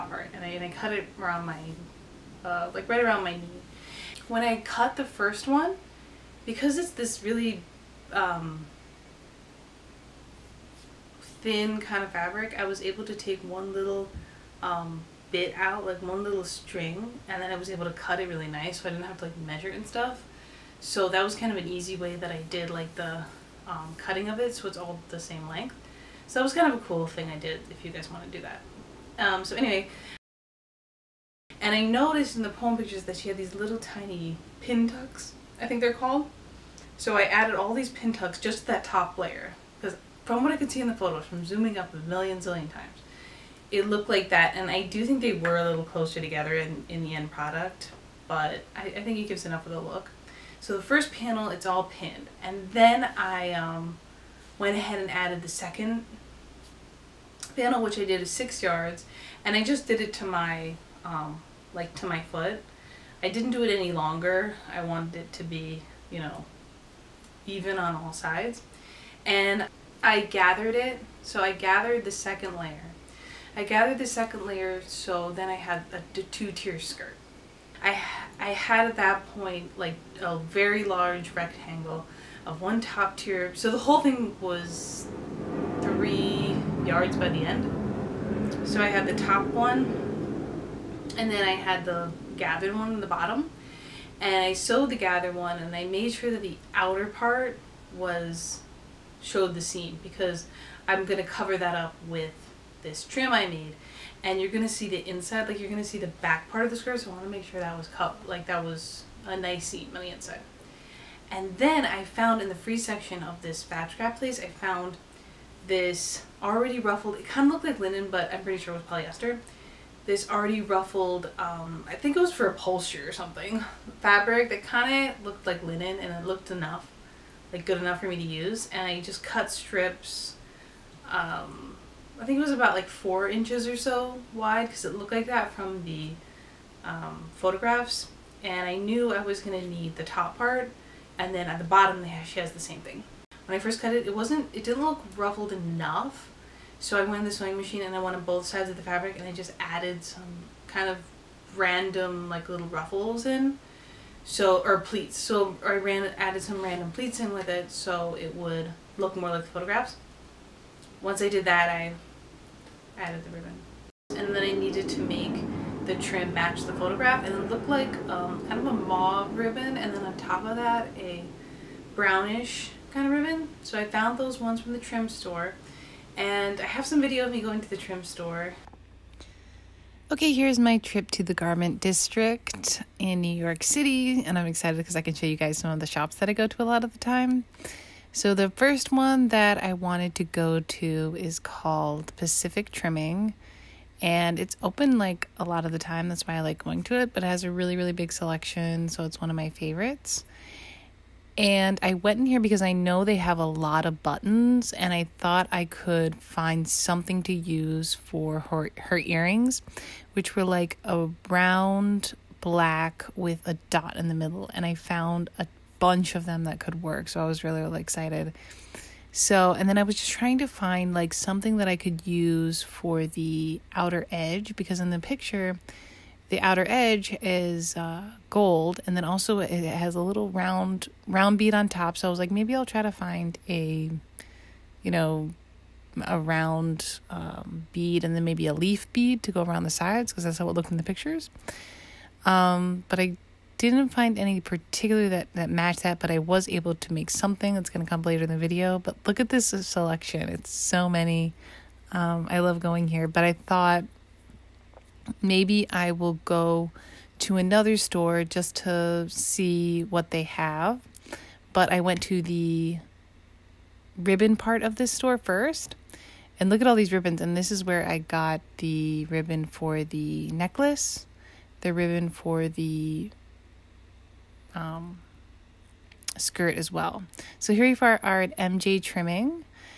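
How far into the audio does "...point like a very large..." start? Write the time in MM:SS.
01:19.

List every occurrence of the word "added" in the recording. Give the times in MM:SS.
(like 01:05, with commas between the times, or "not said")
00:37, 00:55, 02:29, 02:36, 02:42.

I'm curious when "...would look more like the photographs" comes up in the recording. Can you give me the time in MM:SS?
02:38.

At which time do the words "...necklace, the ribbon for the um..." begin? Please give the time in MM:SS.
04:30.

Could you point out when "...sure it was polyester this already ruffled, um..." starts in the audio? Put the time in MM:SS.
01:58.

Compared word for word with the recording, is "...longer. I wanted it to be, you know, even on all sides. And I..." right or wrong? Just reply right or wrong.
right.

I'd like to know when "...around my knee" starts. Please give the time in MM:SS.
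00:03.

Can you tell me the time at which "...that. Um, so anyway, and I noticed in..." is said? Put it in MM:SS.
00:28.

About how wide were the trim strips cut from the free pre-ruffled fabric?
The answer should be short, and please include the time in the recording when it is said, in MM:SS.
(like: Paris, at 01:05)
4 inches, at 02:12.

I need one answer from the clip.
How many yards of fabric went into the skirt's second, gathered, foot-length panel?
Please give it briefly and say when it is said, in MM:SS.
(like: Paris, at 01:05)
6 yards, at 00:58.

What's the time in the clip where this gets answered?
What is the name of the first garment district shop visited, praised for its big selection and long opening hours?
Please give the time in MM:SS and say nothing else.
03:12.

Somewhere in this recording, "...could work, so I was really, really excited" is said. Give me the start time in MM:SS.
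03:36.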